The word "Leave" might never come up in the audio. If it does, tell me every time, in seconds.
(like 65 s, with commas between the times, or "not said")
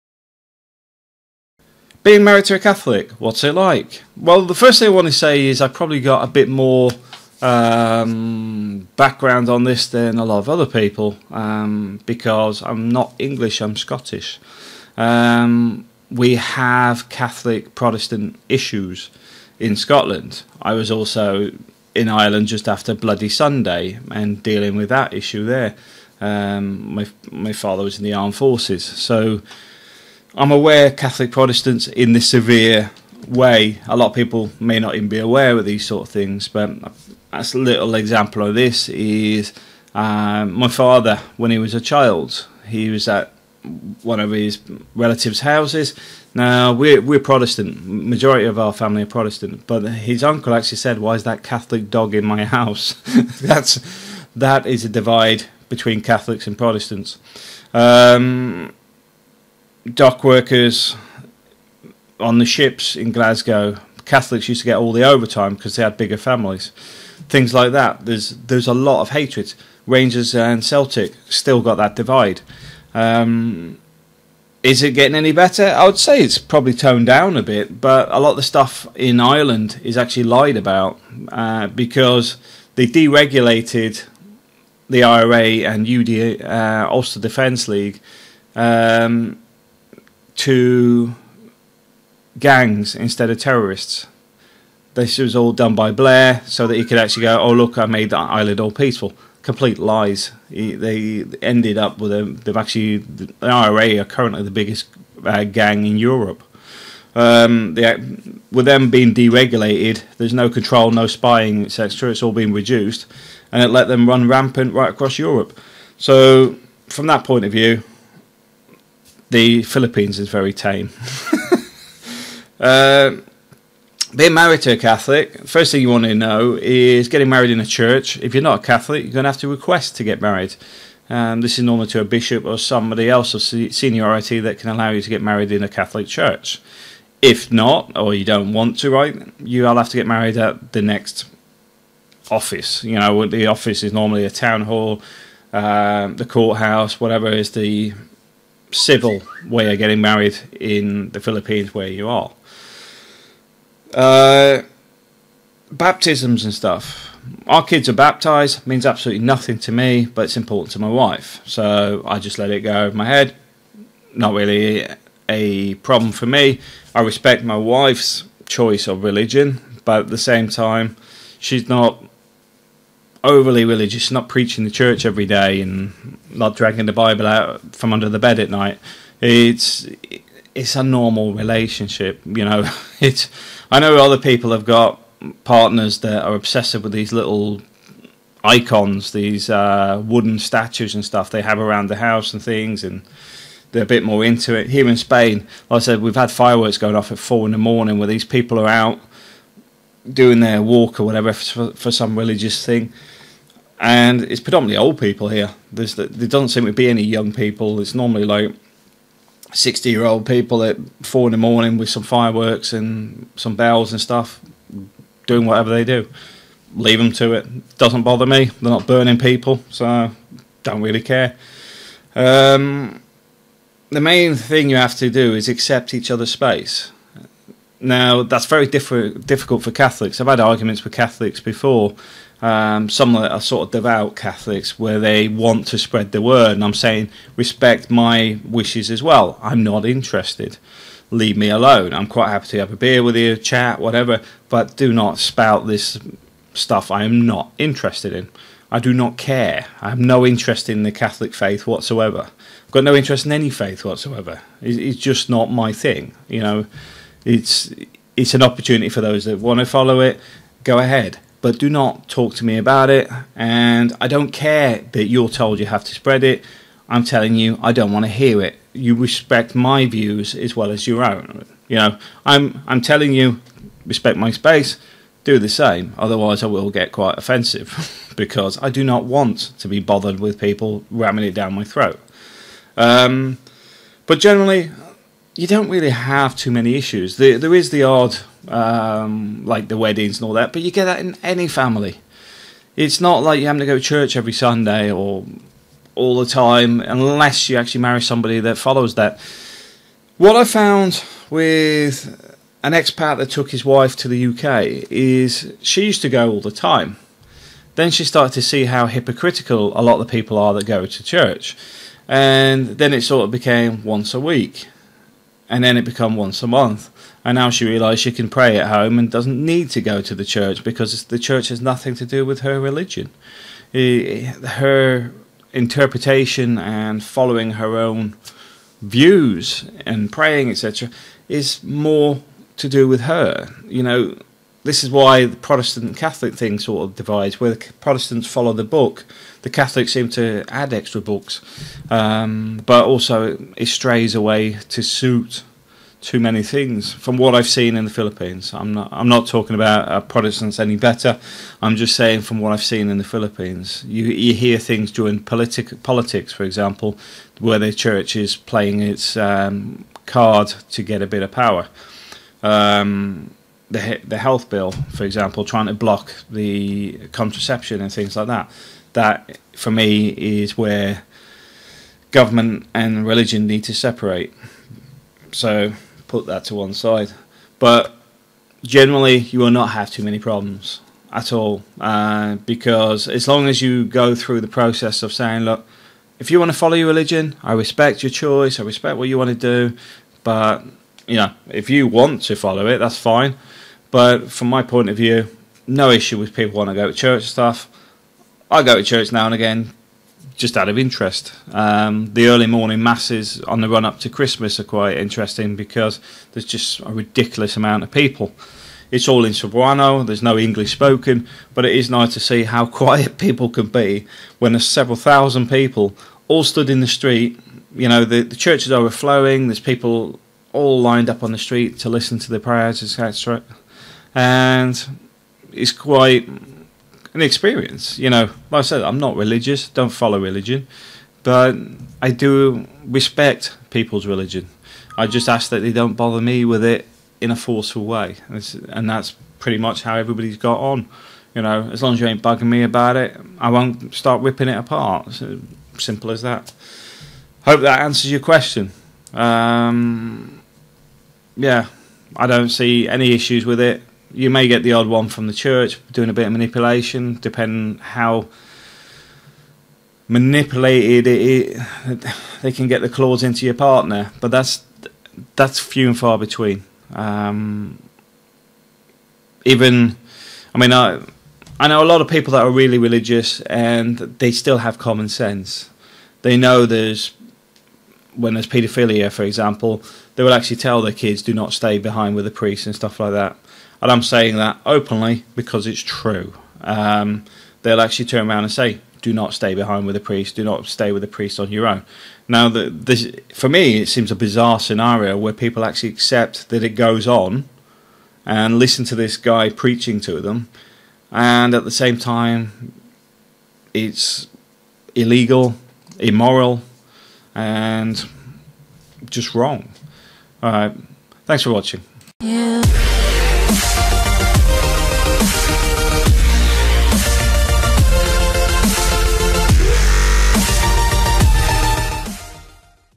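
216 s, 241 s.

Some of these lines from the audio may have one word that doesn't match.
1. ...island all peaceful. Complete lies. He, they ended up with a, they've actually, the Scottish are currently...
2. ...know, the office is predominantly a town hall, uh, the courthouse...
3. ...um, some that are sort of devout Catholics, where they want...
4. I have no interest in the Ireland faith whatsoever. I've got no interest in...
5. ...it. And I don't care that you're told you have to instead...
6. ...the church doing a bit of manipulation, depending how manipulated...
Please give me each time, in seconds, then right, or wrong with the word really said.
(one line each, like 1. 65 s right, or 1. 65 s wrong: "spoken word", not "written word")
1. 98 s wrong: "IRA", not "Scottish"
2. 142 s wrong: "normally", not "predominantly"
3. 232 s right
4. 249 s wrong: "Catholic", not "Ireland"
5. 262 s wrong: "spread", not "instead"
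6. 455 s right.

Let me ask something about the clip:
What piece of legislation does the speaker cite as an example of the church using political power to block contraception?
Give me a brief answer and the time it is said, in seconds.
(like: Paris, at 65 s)
the health bill, at 364 s.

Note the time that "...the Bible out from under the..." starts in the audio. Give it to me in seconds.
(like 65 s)
176 s.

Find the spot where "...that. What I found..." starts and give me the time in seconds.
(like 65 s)
298 s.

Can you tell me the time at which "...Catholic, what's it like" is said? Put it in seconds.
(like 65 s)
2 s.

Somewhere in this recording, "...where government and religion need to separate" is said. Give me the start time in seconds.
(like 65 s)
370 s.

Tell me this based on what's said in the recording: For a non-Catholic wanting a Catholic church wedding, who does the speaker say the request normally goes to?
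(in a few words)
a bishop.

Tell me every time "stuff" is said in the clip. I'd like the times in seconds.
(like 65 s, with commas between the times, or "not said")
78 s, 156 s, 191 s, 213 s, 246 s, 397 s, 482 s.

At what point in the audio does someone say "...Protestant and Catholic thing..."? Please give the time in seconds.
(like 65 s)
335 s.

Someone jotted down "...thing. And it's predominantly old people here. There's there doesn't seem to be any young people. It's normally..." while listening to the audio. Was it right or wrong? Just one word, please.
right.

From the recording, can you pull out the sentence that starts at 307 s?
Then she started to see how hypocritical a lot of the people are that go to church.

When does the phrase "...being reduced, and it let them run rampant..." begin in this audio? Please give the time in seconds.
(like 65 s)
112 s.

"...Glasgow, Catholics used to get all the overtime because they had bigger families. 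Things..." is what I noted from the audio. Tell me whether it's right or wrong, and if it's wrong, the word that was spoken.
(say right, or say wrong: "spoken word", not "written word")
right.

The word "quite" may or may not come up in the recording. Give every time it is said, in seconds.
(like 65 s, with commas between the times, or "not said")
242 s, 276 s, 404 s, 425 s.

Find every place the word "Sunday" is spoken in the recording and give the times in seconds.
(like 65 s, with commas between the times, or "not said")
23 s, 294 s.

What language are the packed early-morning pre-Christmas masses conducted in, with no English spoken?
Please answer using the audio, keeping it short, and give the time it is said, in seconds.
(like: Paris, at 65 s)
Cebuano, at 409 s.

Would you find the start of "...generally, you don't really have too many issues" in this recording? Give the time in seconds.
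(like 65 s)
284 s.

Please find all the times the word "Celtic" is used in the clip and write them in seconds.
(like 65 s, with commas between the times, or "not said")
70 s.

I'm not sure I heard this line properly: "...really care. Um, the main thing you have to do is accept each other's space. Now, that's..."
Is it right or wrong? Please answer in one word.
right.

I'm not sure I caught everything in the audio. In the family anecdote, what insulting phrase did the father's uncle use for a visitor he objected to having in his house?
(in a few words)
Catholic dog.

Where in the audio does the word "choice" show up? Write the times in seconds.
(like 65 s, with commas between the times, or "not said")
168 s, 388 s.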